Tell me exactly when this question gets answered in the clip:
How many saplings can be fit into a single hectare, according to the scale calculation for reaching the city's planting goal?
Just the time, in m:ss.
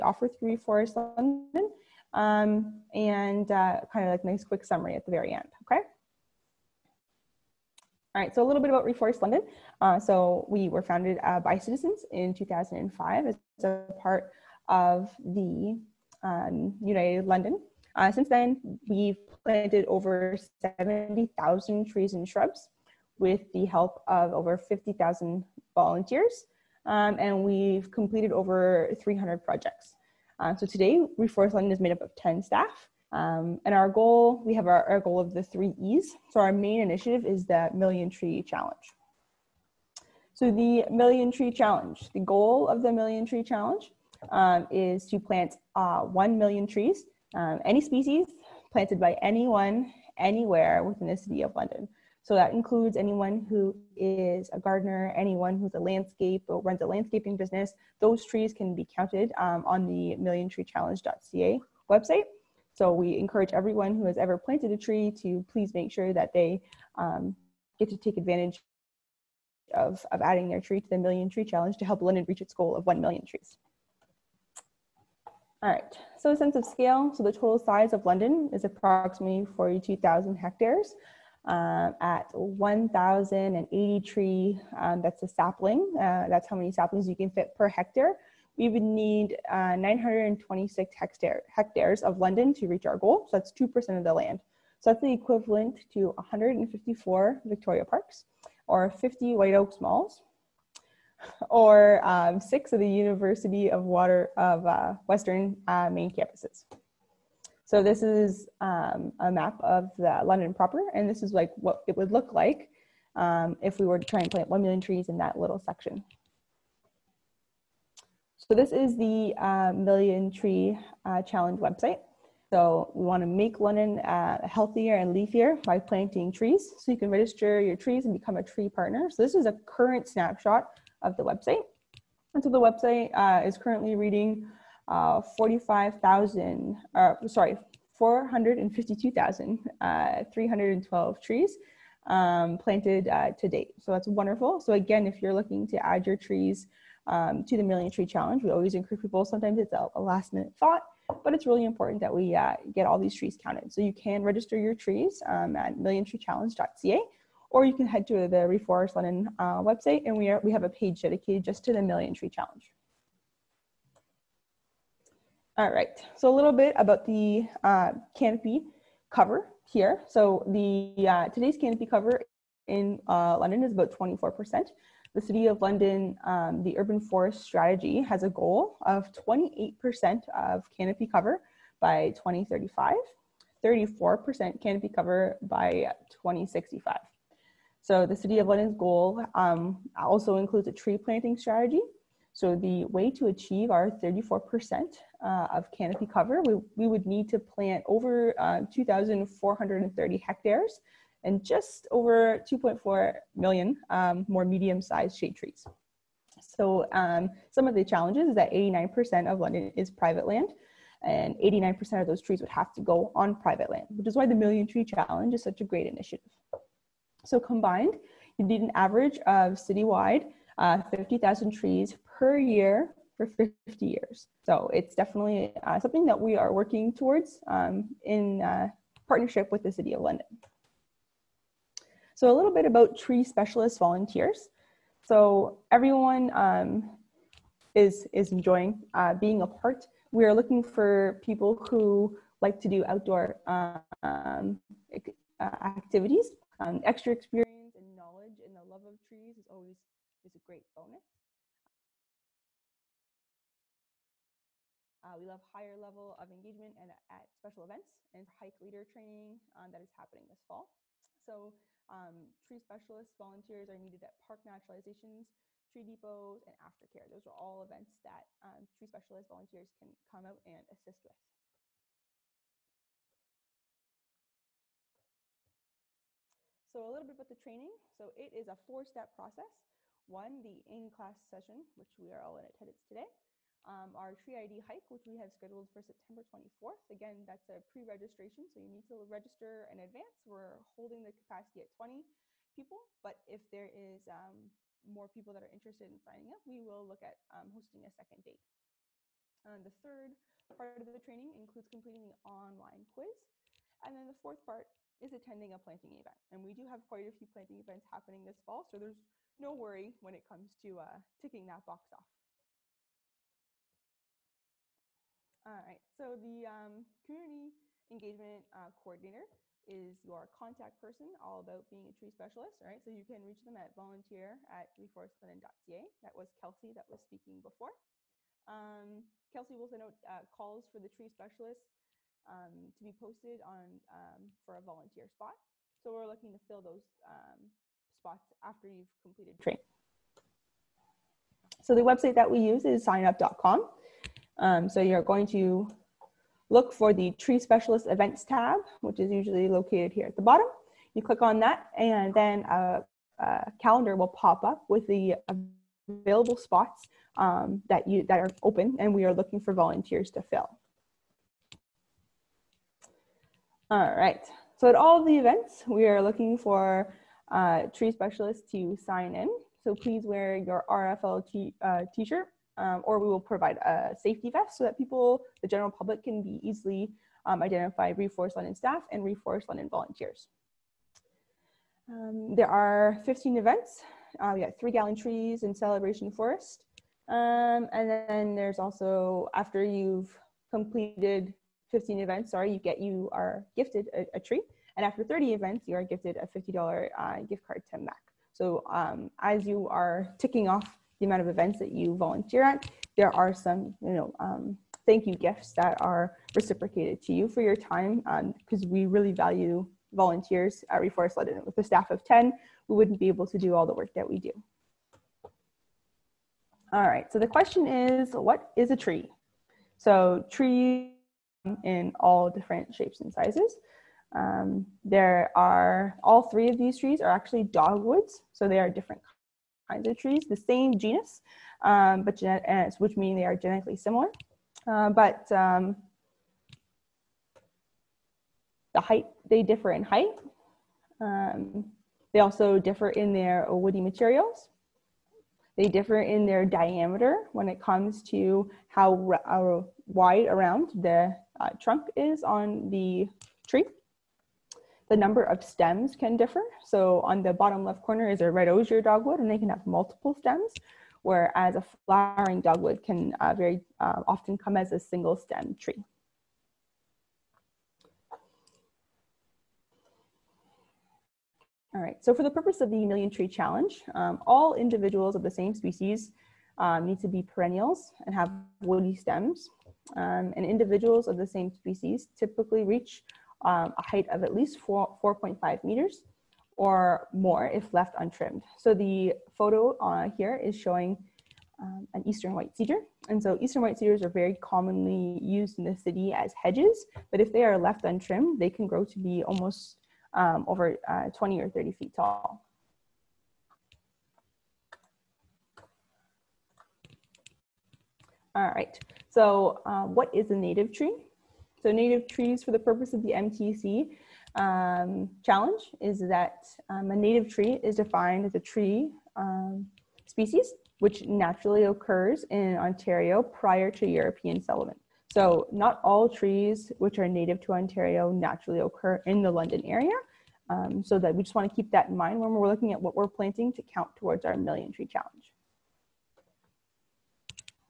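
1:22.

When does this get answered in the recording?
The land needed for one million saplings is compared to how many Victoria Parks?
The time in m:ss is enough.
1:36.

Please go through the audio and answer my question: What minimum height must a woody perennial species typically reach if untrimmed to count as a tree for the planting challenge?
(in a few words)
4.5 meters.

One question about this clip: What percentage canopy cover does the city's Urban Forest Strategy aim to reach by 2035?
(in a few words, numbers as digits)
28%.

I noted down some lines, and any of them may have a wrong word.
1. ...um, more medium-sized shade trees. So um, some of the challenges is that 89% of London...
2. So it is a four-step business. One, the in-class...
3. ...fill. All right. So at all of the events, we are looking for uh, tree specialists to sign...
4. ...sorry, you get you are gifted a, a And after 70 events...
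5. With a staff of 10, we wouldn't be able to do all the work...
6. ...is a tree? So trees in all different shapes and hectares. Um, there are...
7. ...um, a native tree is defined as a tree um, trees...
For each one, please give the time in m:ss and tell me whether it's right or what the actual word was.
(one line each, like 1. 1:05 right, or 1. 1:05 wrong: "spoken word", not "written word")
1. 3:23 right
2. 4:37 wrong: "process", not "business"
3. 6:00 right
4. 6:32 wrong: "30", not "70"
5. 6:51 right
6. 6:58 wrong: "sizes", not "hectares"
7. 8:36 wrong: "species", not "trees".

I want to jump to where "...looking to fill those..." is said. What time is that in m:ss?
5:36.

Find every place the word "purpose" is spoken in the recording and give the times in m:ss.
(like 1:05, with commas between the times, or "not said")
7:52, 8:32.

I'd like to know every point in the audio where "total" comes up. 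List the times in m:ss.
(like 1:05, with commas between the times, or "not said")
1:17.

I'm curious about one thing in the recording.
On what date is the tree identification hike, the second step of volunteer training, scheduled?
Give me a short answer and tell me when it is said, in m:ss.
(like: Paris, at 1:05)
September 24, at 4:45.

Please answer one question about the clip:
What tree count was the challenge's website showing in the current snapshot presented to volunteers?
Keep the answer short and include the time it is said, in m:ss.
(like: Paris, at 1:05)
452,312, at 2:17.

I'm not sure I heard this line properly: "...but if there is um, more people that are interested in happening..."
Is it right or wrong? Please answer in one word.
wrong.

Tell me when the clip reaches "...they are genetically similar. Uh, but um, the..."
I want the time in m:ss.
7:13.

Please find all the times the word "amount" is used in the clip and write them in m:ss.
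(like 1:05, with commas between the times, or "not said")
6:41.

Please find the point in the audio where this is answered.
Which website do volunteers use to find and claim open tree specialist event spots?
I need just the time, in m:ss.
5:42.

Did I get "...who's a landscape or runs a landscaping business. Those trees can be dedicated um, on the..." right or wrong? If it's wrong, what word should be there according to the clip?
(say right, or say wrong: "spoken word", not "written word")
wrong: "counted", not "dedicated".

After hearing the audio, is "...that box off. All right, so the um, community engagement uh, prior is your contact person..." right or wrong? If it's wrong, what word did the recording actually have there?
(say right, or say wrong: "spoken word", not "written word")
wrong: "coordinator", not "prior".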